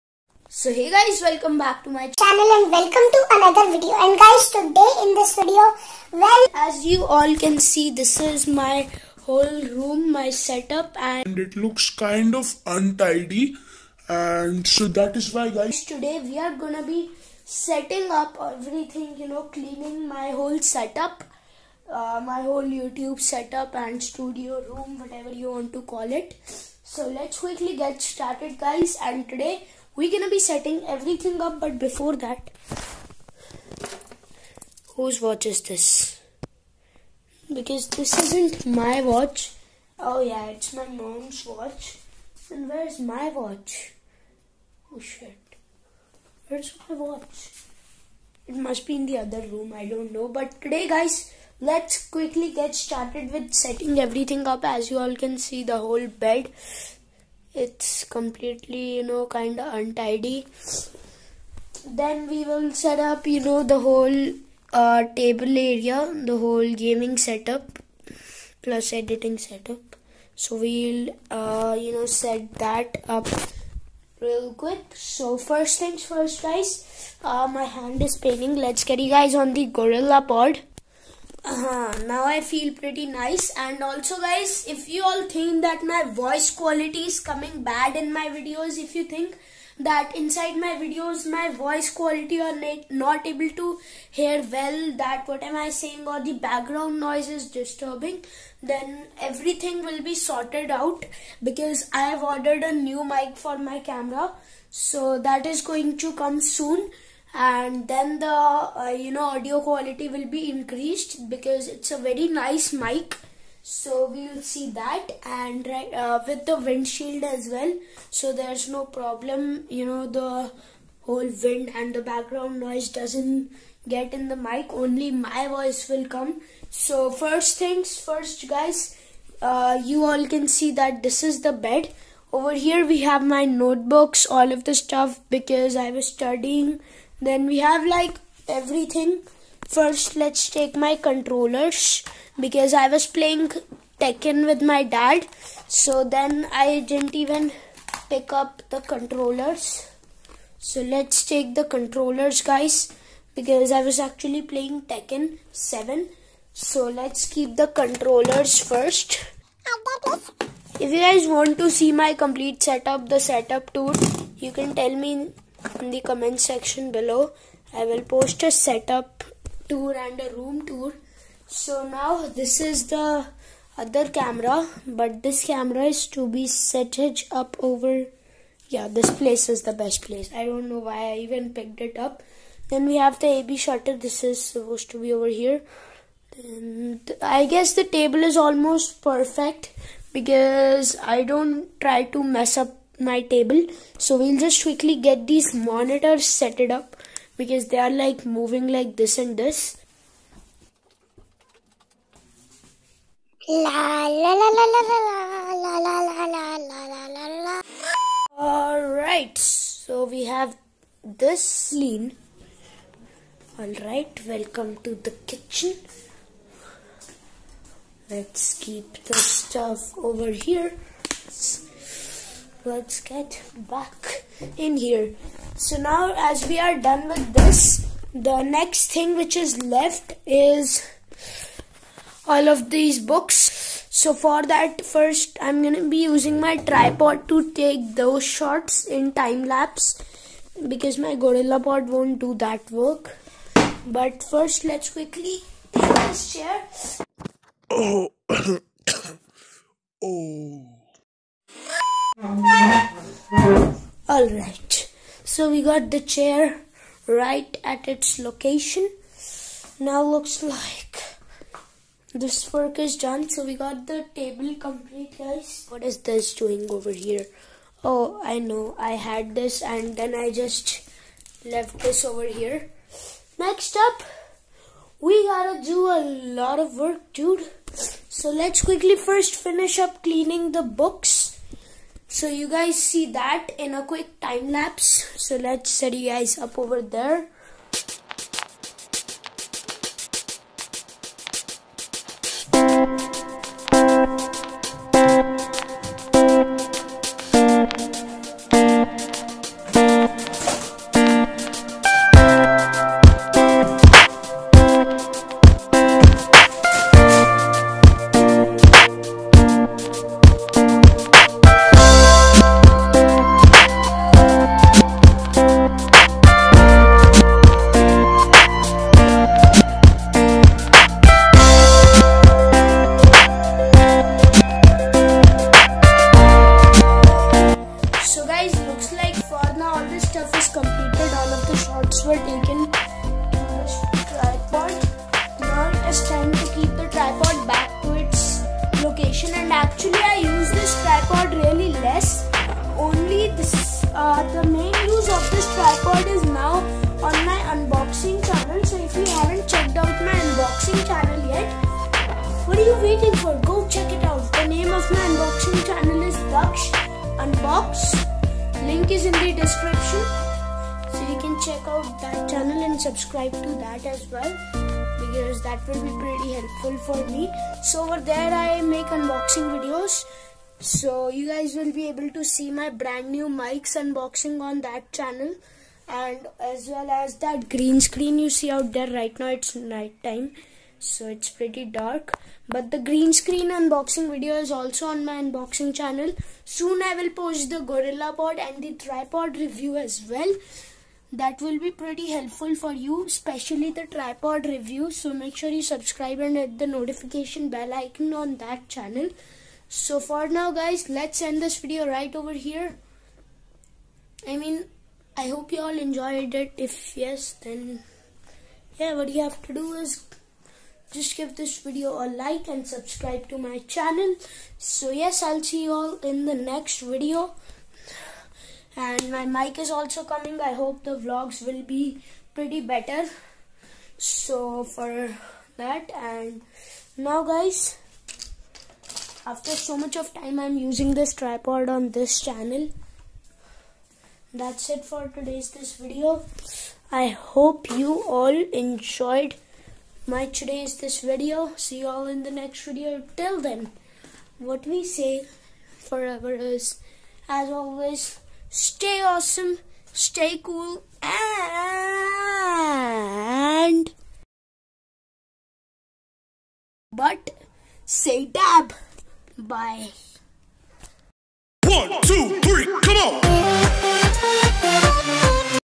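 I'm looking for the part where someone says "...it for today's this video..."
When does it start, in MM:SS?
07:14.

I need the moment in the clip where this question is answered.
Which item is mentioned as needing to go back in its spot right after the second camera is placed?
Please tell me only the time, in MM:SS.
03:03.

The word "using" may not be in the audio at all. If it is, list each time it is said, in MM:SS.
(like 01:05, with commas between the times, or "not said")
03:56, 07:10.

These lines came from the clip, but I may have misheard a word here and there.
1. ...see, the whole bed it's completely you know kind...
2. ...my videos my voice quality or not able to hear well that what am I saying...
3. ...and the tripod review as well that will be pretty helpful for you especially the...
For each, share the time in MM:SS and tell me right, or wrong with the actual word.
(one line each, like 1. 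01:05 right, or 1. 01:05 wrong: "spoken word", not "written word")
1. 00:55 right
2. 01:30 right
3. 06:28 right.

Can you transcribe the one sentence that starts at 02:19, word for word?
First, let's take my controllers because I was playing Tekken with my dad.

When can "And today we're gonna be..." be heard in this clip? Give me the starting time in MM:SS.
00:29.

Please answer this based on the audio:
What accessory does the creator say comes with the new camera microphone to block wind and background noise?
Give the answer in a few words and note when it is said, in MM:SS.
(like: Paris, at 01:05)
Windshield, at 01:56.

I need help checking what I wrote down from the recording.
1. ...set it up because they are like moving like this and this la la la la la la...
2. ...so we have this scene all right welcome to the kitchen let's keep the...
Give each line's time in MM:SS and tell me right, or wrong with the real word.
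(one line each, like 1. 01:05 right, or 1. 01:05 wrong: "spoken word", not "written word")
1. 03:16 right
2. 03:29 right.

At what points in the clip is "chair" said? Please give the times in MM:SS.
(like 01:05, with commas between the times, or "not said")
04:06, 04:16.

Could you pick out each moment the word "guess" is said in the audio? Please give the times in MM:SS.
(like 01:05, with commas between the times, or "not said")
03:07.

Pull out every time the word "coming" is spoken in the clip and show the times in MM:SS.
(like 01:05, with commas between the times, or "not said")
01:27, 07:00.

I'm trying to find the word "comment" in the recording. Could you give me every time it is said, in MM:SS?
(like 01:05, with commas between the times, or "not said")
02:46.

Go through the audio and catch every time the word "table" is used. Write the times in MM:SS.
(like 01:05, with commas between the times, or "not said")
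01:05, 03:07, 03:13, 04:24.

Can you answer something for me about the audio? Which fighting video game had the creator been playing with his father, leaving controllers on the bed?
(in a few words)
Tekken 7.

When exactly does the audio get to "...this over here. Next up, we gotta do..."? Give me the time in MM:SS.
04:31.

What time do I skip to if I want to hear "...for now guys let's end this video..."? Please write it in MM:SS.
06:39.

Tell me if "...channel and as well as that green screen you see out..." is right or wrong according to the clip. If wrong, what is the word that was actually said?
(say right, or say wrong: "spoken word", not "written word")
right.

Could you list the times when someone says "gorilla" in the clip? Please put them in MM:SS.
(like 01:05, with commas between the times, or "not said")
01:19, 04:01, 06:27.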